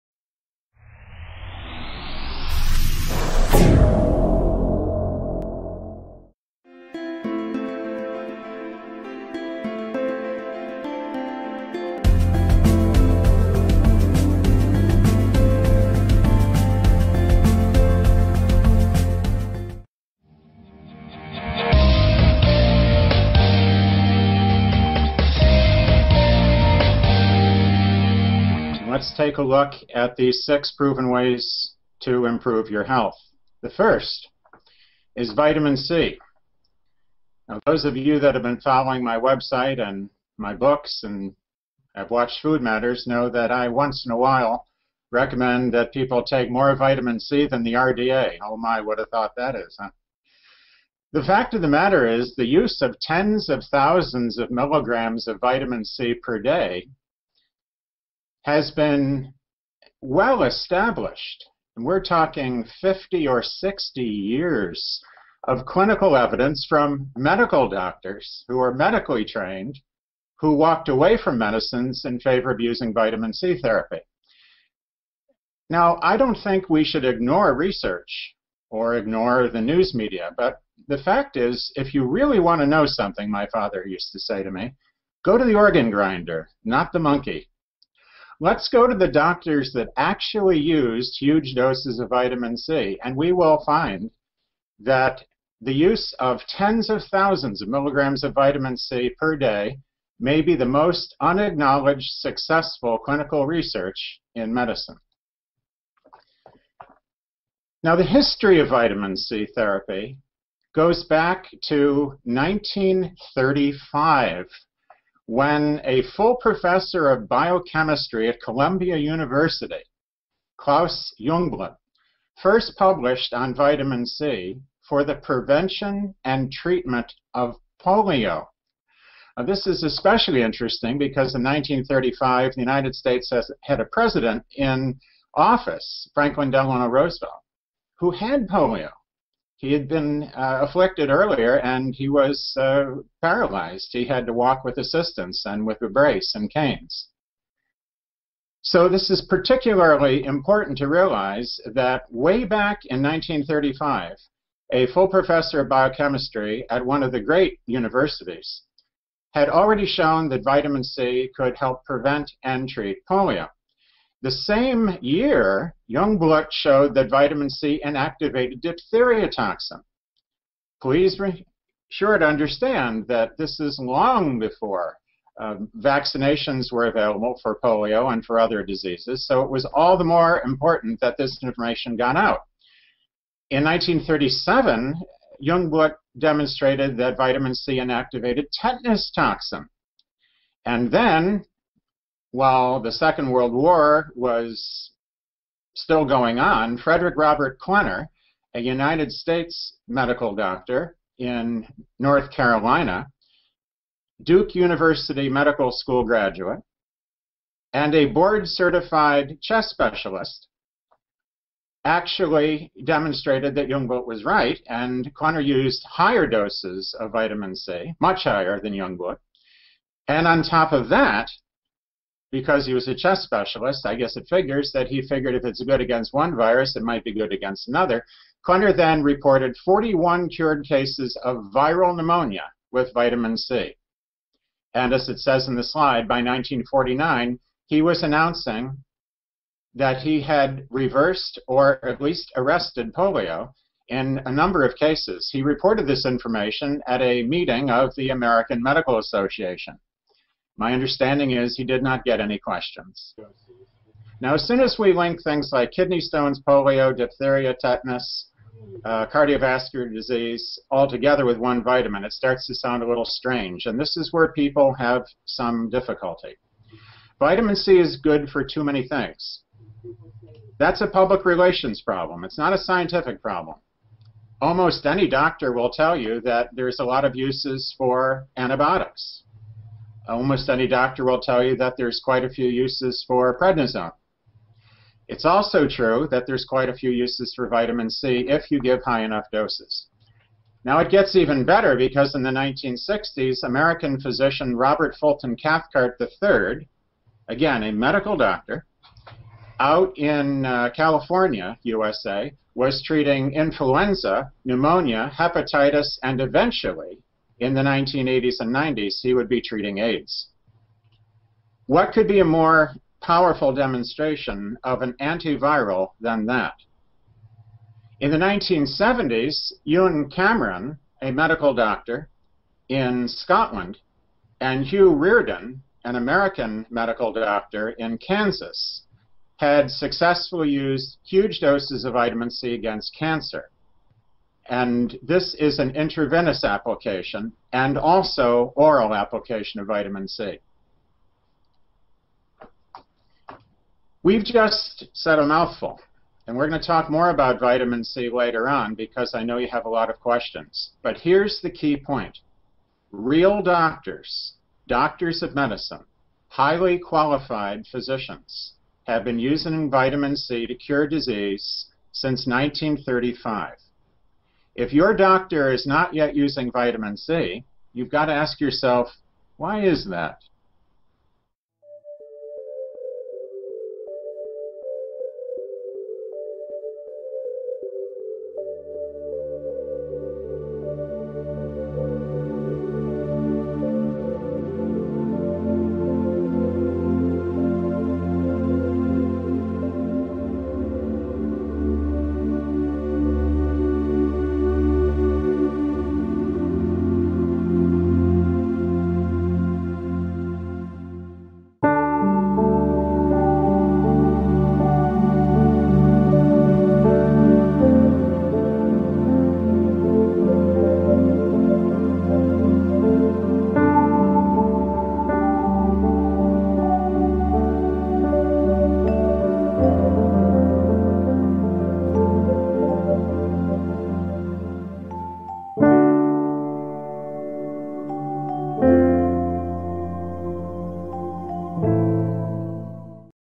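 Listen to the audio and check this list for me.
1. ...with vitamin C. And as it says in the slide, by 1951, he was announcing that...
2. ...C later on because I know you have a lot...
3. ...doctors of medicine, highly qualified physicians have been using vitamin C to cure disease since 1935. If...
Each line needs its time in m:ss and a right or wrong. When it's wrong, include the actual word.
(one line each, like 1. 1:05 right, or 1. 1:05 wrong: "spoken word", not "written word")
1. 3:52 wrong: "1949", not "1951"
2. 5:47 right
3. 5:54 right.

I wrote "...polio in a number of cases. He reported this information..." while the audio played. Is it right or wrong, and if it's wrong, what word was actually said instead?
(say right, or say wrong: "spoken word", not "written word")
right.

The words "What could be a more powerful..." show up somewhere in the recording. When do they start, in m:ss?
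5:11.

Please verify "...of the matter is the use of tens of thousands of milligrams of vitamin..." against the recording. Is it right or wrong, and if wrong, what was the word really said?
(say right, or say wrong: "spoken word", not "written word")
right.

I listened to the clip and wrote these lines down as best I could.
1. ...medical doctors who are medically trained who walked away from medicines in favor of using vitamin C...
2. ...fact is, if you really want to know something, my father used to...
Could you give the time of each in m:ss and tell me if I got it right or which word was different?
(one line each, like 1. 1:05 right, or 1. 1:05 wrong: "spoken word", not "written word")
1. 1:07 right
2. 1:20 right.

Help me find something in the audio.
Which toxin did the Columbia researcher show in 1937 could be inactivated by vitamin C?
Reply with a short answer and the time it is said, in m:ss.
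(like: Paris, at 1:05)
Tetanus toxin, at 3:08.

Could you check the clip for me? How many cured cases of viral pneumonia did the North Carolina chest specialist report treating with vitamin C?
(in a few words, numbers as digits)
41.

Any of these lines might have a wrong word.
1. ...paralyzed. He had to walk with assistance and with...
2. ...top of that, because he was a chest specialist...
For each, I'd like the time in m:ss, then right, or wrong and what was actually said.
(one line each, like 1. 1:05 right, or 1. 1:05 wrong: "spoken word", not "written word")
1. 2:23 right
2. 3:40 right.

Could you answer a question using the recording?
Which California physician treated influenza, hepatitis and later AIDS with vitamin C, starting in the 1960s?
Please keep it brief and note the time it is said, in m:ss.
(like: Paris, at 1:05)
Robert Fulton Cathcart III, at 4:54.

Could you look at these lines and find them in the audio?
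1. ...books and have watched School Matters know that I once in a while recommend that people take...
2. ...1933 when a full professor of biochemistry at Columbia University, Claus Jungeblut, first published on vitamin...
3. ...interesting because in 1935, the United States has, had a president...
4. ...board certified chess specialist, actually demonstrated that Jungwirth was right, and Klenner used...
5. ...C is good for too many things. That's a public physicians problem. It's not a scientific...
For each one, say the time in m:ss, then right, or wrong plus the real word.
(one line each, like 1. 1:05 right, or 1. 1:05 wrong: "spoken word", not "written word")
1. 0:40 wrong: "Food", not "School"
2. 1:52 wrong: "1935", not "1933"
3. 2:10 right
4. 3:28 right
5. 4:27 wrong: "relations", not "physicians".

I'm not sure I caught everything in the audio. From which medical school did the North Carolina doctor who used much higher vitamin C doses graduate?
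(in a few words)
Duke University Medical School.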